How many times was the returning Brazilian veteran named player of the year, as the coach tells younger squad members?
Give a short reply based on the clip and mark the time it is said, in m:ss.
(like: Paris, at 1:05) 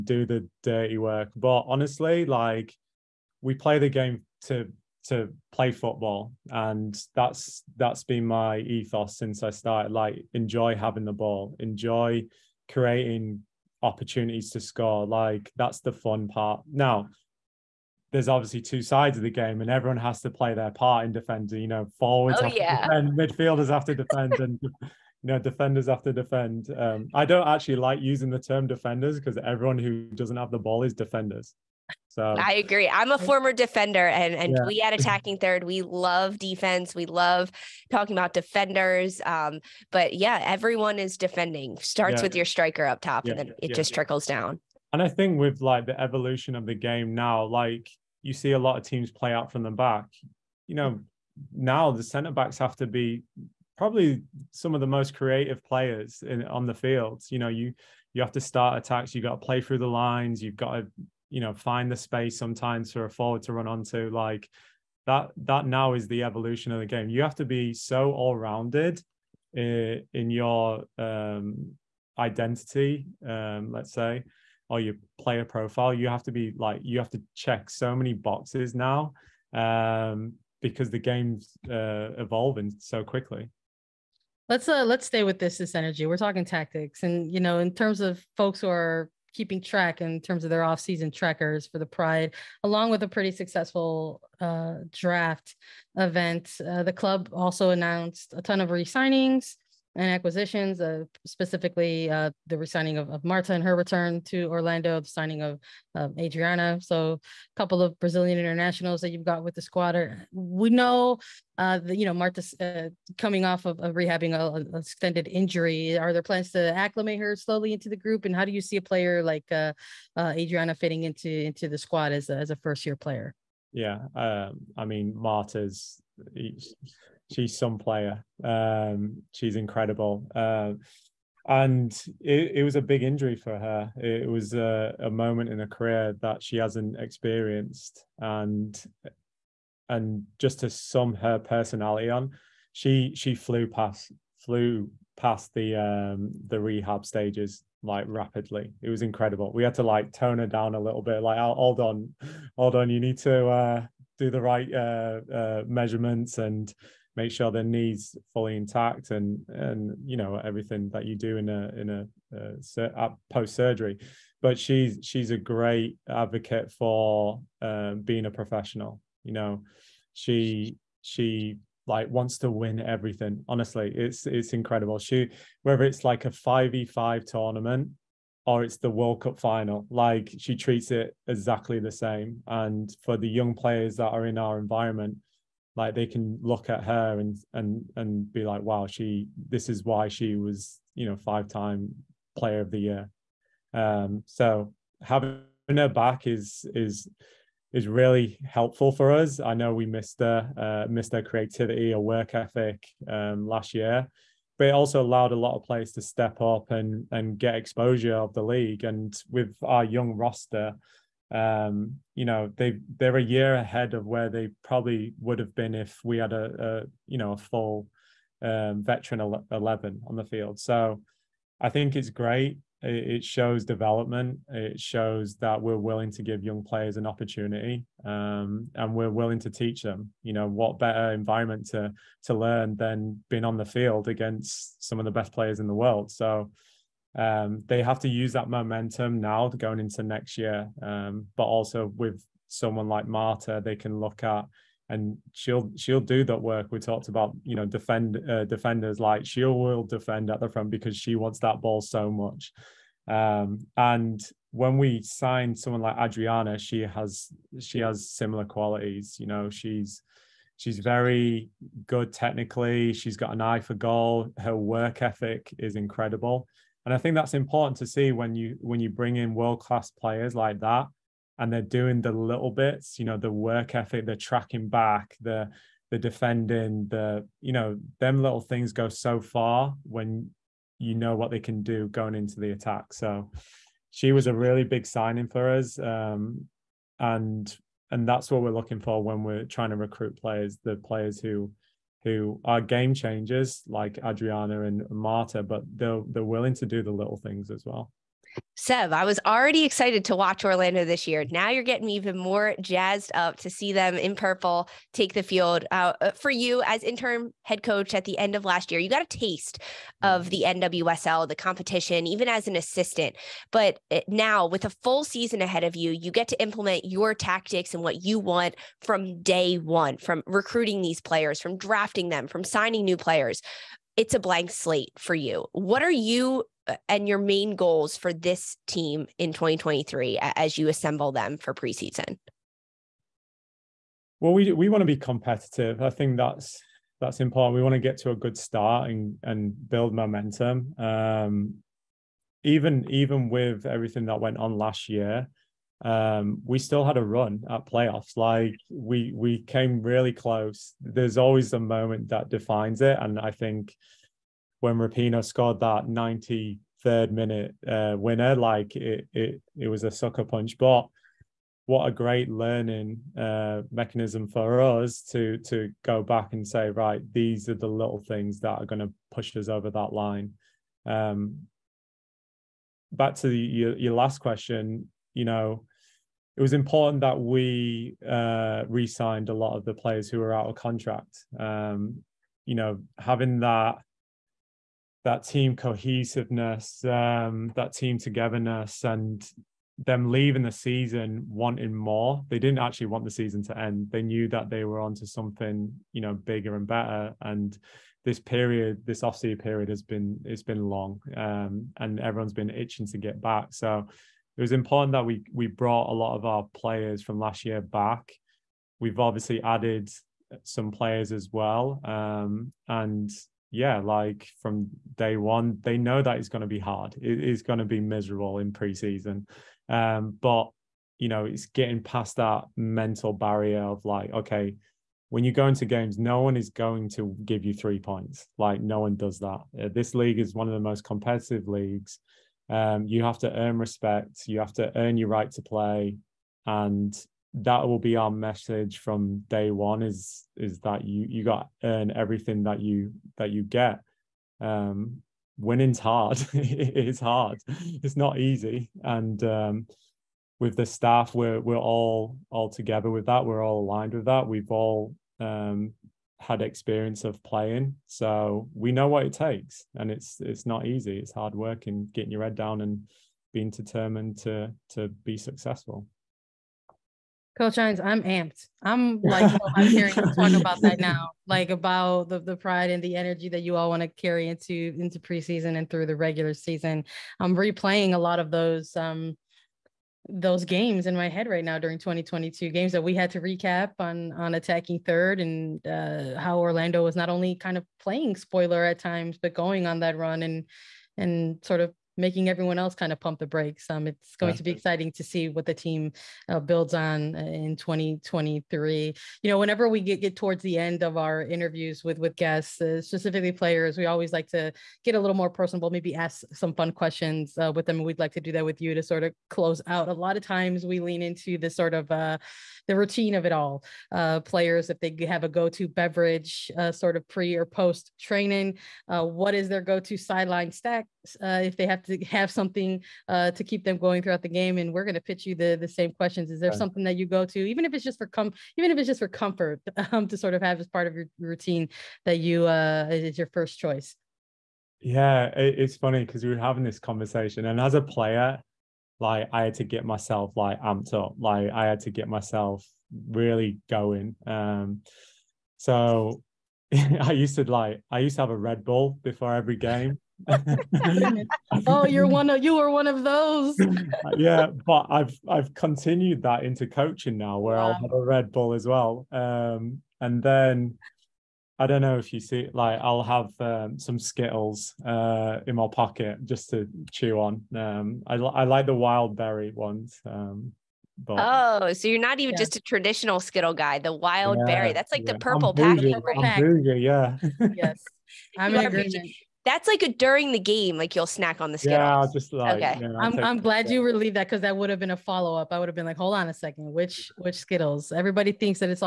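5, at 3:11.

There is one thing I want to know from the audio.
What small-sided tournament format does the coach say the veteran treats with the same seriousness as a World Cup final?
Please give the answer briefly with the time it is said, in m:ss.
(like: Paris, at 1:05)
5v5, at 2:56.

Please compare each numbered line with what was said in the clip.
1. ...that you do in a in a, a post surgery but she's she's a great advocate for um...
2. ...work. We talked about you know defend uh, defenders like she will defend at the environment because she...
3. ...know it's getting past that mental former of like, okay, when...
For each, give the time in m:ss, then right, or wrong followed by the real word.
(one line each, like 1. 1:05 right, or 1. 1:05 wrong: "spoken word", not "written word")
1. 2:40 right
2. 4:06 wrong: "front", not "environment"
3. 7:01 wrong: "barrier", not "former".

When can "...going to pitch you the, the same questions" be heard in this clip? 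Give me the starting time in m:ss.
8:44.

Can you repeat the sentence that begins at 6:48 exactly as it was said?
We've obviously added some players as well, um, and yeah, like from day one, they know that it's going to be hard.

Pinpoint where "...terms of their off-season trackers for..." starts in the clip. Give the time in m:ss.
1:30.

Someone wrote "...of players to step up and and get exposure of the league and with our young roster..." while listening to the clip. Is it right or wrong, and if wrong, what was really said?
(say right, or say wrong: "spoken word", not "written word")
right.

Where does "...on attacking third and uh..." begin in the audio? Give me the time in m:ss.
8:04.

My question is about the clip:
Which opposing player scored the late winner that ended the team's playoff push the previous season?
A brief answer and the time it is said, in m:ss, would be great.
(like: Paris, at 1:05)
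Rapinoe, at 5:54.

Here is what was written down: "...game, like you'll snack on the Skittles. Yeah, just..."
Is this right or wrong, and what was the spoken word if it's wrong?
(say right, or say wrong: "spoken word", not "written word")
right.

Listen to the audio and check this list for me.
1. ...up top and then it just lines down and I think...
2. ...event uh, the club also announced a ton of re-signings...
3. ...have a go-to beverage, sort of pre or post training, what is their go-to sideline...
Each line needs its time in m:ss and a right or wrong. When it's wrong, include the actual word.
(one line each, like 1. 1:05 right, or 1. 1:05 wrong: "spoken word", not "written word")
1. 0:42 wrong: "trickles", not "lines"
2. 1:35 right
3. 8:35 right.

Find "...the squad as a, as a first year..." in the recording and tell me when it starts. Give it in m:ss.
2:01.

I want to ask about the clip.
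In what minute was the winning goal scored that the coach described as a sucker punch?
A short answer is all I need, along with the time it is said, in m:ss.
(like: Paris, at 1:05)
93rd, at 5:55.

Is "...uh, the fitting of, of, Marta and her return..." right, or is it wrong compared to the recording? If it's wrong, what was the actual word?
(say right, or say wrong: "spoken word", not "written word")
wrong: "resigning", not "fitting".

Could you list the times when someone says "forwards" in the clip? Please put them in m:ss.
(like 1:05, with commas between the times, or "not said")
0:21, 1:03.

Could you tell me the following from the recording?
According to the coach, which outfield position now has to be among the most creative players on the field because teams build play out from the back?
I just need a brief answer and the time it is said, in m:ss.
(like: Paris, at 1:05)
Centre backs, at 0:52.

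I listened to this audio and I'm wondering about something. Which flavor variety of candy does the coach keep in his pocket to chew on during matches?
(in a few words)
Wild berry.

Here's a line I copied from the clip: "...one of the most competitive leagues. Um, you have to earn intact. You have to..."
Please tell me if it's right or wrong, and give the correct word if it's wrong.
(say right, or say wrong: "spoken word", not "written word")
wrong: "respect", not "intact".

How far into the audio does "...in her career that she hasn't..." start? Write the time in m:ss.
2:15.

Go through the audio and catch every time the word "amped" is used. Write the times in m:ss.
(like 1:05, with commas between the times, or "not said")
7:48, 9:00.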